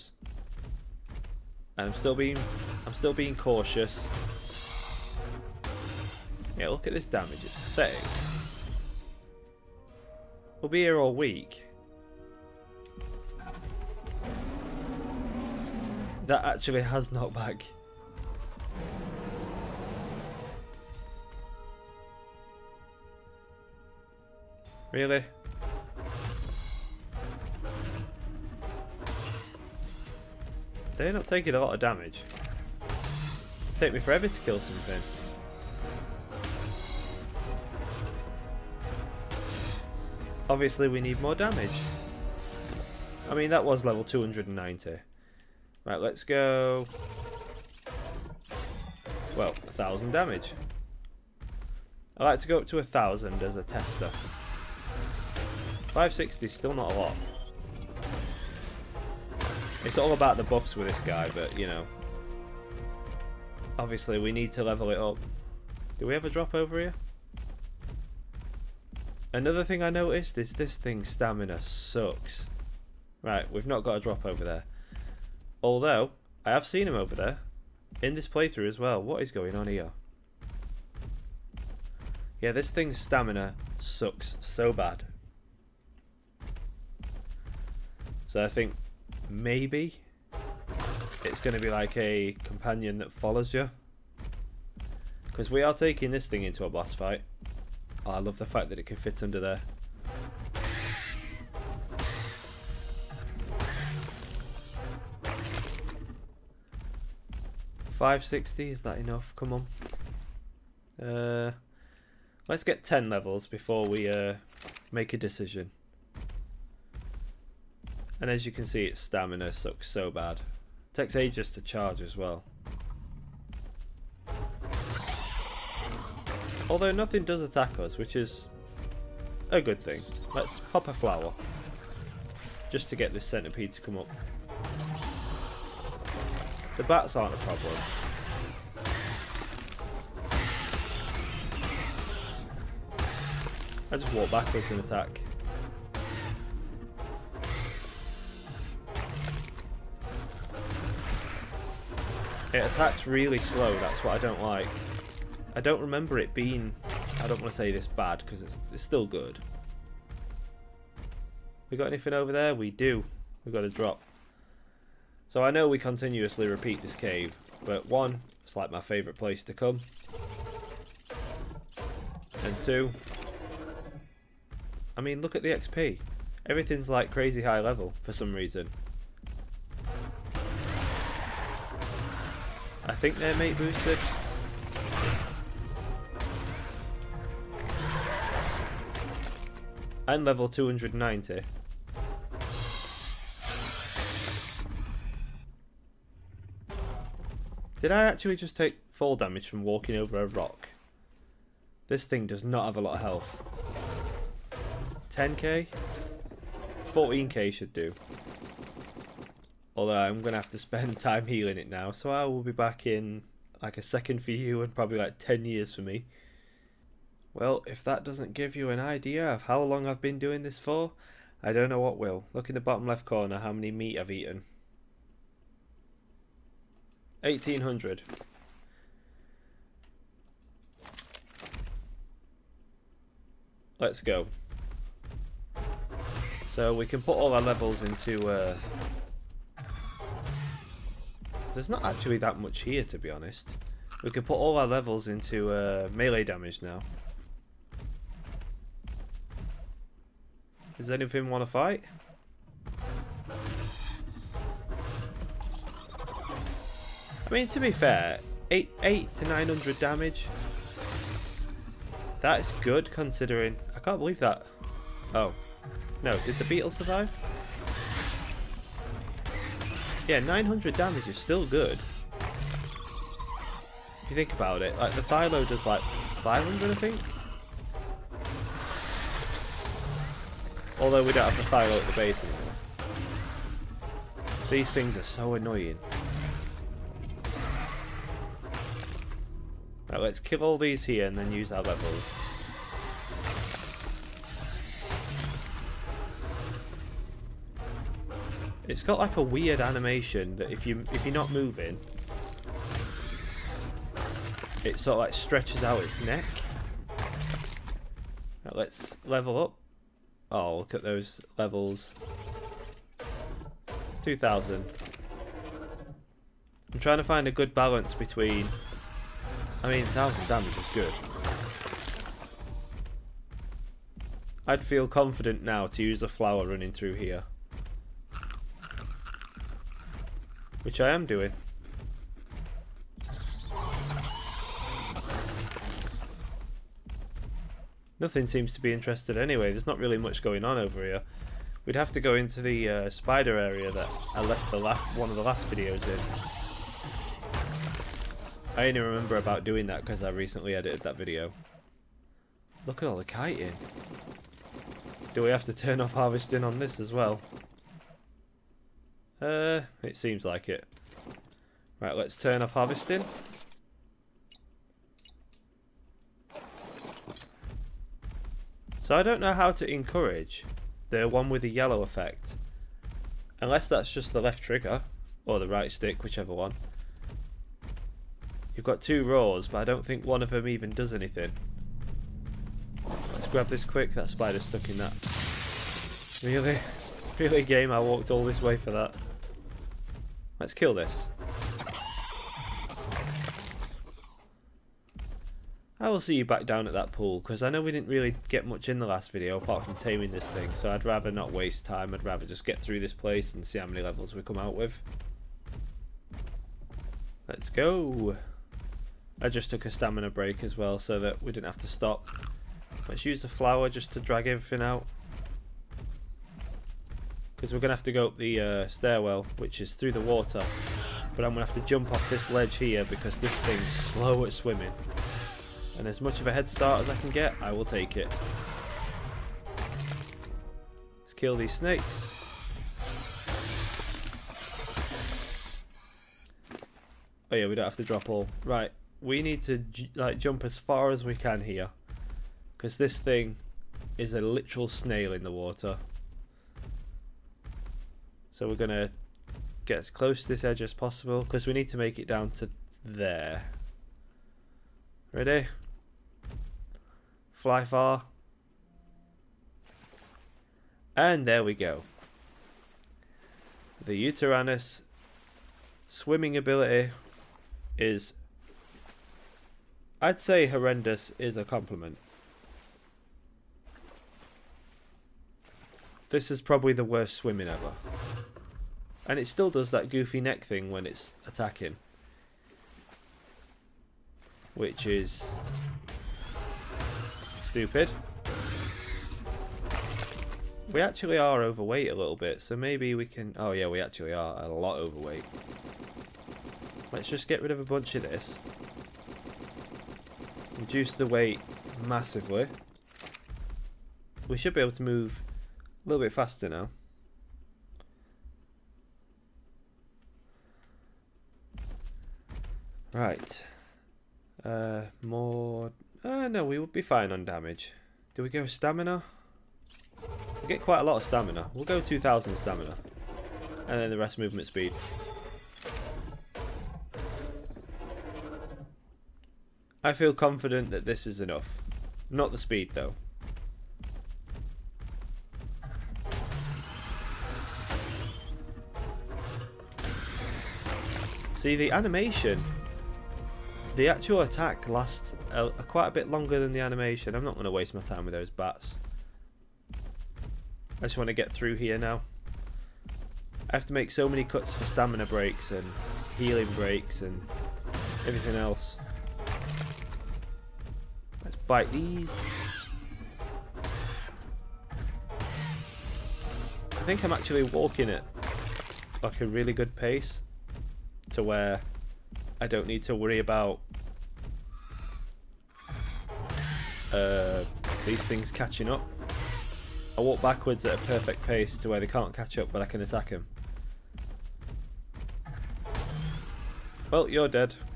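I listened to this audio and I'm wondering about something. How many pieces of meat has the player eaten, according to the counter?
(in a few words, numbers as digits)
1800.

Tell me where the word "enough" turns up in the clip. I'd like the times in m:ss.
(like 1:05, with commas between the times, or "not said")
1:48, 8:51.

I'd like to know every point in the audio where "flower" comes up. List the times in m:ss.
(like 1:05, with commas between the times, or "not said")
2:10, 5:26, 6:53.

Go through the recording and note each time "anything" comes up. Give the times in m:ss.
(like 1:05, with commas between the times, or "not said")
2:41, 4:10, 6:20.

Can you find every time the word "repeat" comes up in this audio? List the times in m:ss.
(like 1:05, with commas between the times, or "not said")
2:46.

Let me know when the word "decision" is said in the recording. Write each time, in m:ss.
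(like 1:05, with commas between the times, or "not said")
1:55.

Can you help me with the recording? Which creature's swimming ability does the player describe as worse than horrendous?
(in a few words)
Uteranus.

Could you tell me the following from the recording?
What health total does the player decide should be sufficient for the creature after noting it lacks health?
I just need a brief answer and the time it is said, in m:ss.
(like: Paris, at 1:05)
14k, at 3:26.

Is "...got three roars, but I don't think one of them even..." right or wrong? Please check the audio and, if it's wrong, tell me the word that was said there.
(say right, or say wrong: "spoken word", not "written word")
wrong: "two", not "three".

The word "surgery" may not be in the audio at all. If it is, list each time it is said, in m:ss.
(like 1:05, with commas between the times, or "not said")
not said.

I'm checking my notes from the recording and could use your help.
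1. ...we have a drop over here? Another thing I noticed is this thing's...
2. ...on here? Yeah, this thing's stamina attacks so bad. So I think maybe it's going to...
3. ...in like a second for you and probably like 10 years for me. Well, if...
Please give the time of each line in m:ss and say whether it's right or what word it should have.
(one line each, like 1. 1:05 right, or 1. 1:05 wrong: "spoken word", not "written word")
1. 1:06 right
2. 1:19 wrong: "sucks", not "attacks"
3. 3:32 right.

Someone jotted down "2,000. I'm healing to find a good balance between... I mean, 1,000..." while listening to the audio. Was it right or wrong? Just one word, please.
wrong.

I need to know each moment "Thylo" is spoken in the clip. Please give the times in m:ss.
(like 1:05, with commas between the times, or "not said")
4:35, 4:41.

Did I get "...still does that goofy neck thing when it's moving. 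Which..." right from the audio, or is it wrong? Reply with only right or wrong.
wrong.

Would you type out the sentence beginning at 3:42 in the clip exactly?
Look in the bottom left corner how many meat I've eaten.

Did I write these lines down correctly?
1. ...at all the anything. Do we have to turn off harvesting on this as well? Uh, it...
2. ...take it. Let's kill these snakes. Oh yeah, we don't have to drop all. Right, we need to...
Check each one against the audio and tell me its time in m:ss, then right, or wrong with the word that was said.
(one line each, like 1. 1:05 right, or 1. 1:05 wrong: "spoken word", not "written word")
1. 5:52 wrong: "kiting", not "anything"
2. 7:07 right.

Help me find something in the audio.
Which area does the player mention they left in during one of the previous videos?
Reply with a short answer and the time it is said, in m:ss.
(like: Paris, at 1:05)
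spider area, at 5:42.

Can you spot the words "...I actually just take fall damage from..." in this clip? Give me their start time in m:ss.
3:17.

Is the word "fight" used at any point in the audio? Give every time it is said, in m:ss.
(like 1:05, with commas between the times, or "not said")
1:36, 4:11.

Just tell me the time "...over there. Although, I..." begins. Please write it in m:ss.
1:14.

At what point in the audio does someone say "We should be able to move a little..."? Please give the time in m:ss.
8:24.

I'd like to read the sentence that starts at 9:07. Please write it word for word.
I'm not going to waste my time with those bats.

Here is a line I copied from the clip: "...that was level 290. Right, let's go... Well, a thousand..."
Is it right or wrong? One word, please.
right.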